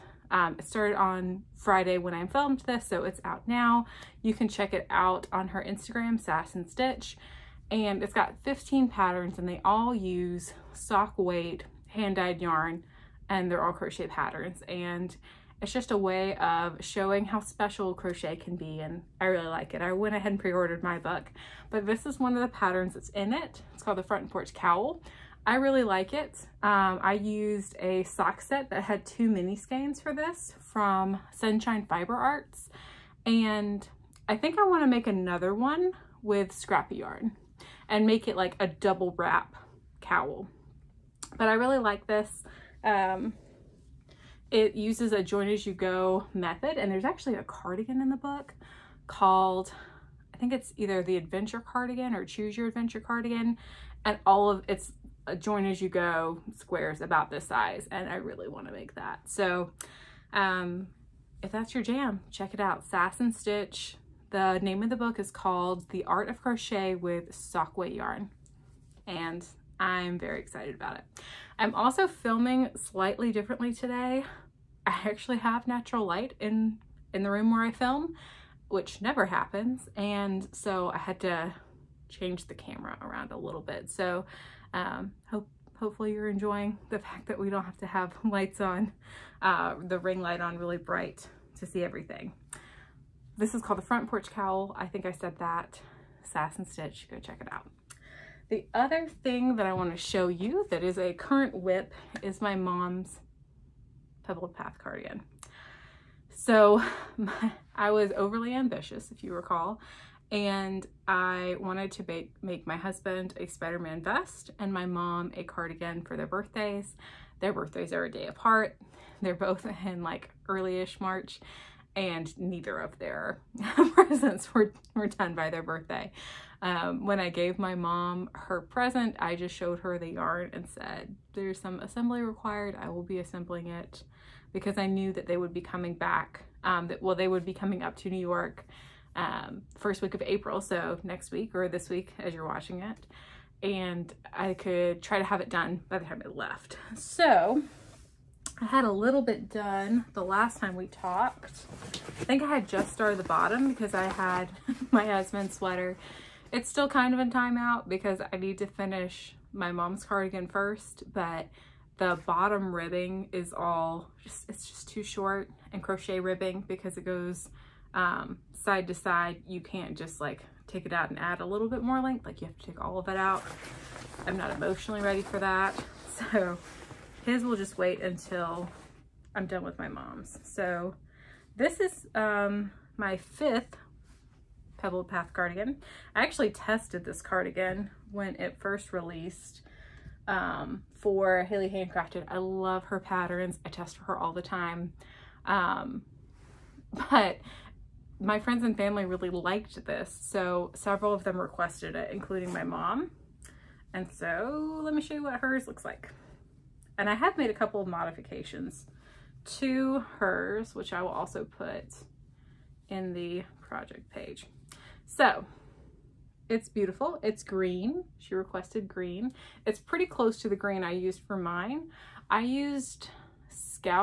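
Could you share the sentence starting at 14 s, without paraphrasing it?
And it's just a way of showing how special crochet can be and I really like it.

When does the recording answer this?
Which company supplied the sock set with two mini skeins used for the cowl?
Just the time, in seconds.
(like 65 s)
31 s.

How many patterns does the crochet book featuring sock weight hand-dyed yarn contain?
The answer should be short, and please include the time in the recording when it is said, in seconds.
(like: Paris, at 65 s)
15, at 8 s.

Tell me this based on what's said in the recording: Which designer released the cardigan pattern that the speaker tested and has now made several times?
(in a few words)
Haley Handcrafted.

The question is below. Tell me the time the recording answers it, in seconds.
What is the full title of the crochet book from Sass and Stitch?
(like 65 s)
65 s.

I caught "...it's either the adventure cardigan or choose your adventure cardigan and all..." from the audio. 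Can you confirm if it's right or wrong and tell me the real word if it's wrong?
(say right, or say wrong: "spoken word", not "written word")
right.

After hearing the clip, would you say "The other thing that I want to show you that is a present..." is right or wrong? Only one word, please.
wrong.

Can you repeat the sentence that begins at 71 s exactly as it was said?
I'm also filming slightly differently today.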